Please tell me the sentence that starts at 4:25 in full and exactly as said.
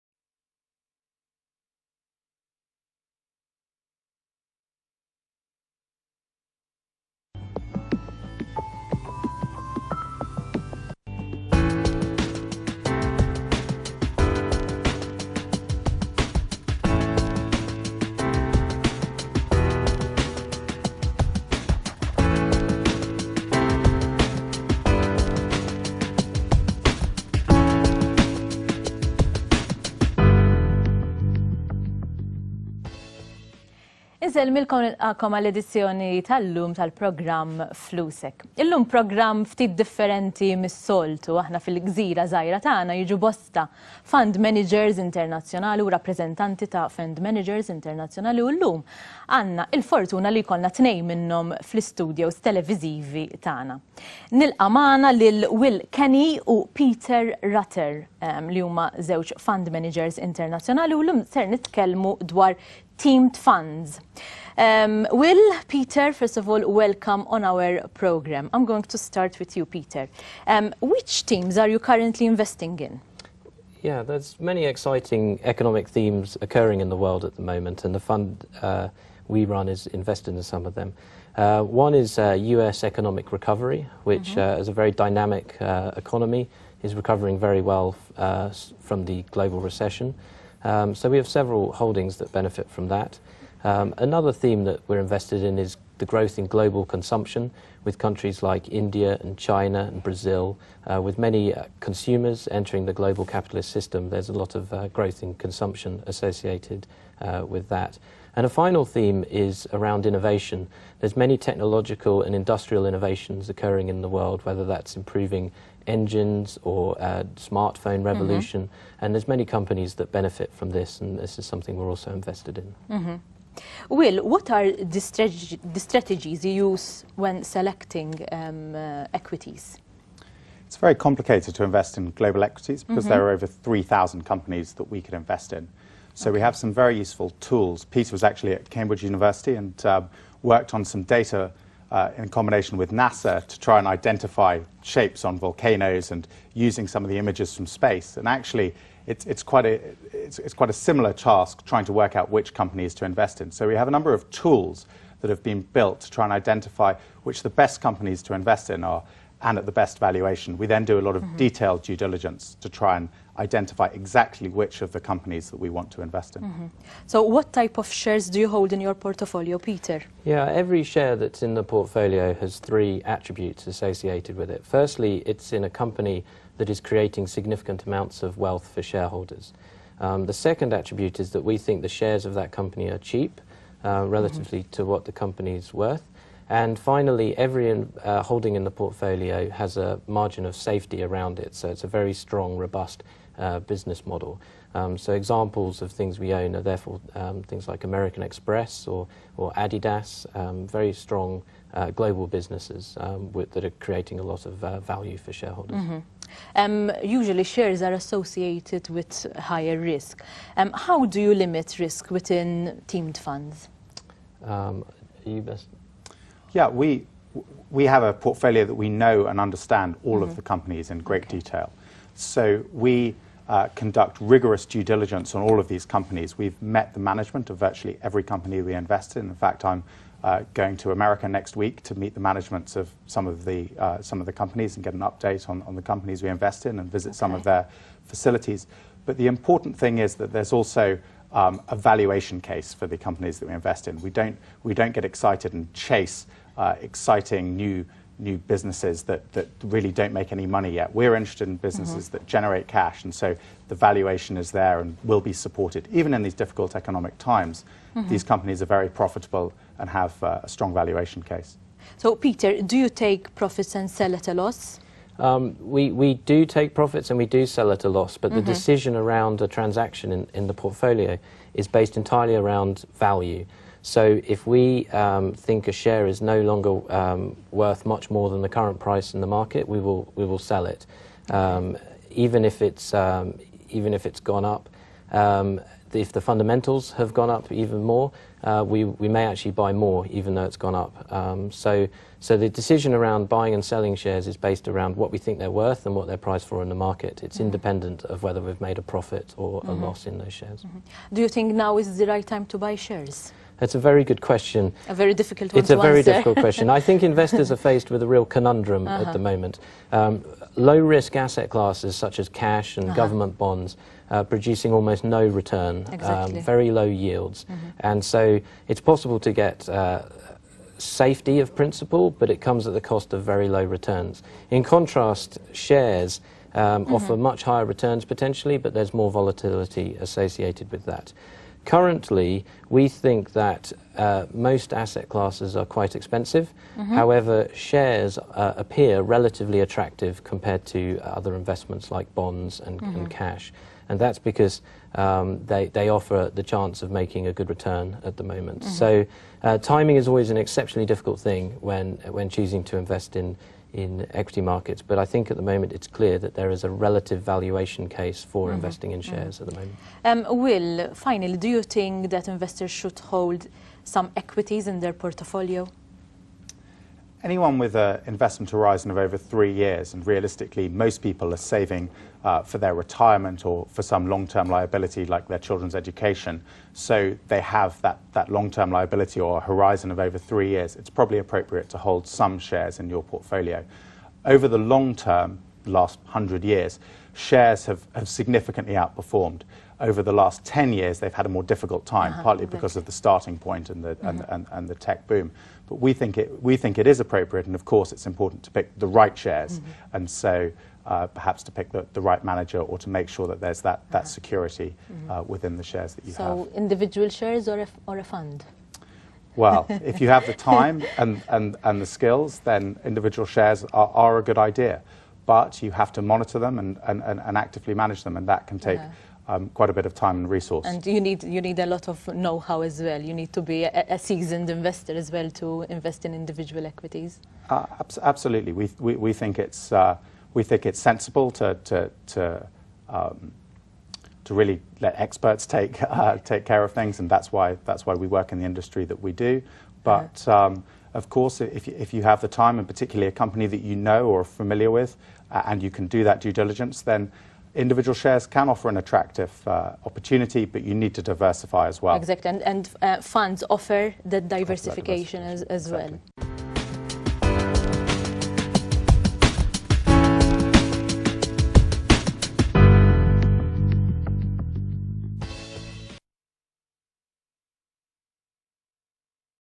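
Um, we, we do take profits and we do sell at a loss, but mm-hmm.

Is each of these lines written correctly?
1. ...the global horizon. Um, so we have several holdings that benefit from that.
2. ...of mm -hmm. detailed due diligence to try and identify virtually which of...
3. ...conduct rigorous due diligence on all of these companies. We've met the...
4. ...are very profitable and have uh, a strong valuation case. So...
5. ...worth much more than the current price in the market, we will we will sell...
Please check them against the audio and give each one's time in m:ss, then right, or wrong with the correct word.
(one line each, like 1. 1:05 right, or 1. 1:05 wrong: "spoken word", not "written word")
1. 1:29 wrong: "recession", not "horizon"
2. 2:41 wrong: "exactly", not "virtually"
3. 3:43 right
4. 4:18 right
5. 4:37 right.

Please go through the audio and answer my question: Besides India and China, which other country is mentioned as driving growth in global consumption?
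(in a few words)
Brazil.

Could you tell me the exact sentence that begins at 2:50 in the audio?
Yeah, every share that's in the portfolio has three attributes associated with it.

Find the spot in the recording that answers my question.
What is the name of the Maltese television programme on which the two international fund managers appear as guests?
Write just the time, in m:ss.
0:37.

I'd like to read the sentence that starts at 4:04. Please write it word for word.
We don't get excited and chase uh, exciting new new businesses that, that really don't make any money yet.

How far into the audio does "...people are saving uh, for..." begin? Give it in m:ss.
6:11.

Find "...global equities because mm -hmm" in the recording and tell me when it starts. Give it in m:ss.
2:12.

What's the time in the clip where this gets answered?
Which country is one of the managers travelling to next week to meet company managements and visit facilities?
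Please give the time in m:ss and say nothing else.
3:50.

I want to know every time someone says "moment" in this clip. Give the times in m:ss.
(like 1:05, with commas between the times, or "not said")
1:17, 5:09, 5:48, 5:55, 6:00.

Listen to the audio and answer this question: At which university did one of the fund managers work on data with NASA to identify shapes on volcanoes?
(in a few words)
Cambridge University.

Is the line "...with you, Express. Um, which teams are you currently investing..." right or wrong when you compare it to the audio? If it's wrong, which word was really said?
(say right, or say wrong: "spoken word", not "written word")
wrong: "Peter", not "Express".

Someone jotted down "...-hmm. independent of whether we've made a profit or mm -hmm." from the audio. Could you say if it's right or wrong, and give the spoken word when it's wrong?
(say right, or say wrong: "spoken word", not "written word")
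right.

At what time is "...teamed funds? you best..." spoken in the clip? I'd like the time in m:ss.
3:32.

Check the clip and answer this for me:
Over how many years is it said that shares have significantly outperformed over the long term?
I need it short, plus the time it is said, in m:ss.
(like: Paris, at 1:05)
100, at 6:26.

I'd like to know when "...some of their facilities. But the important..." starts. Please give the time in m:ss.
3:57.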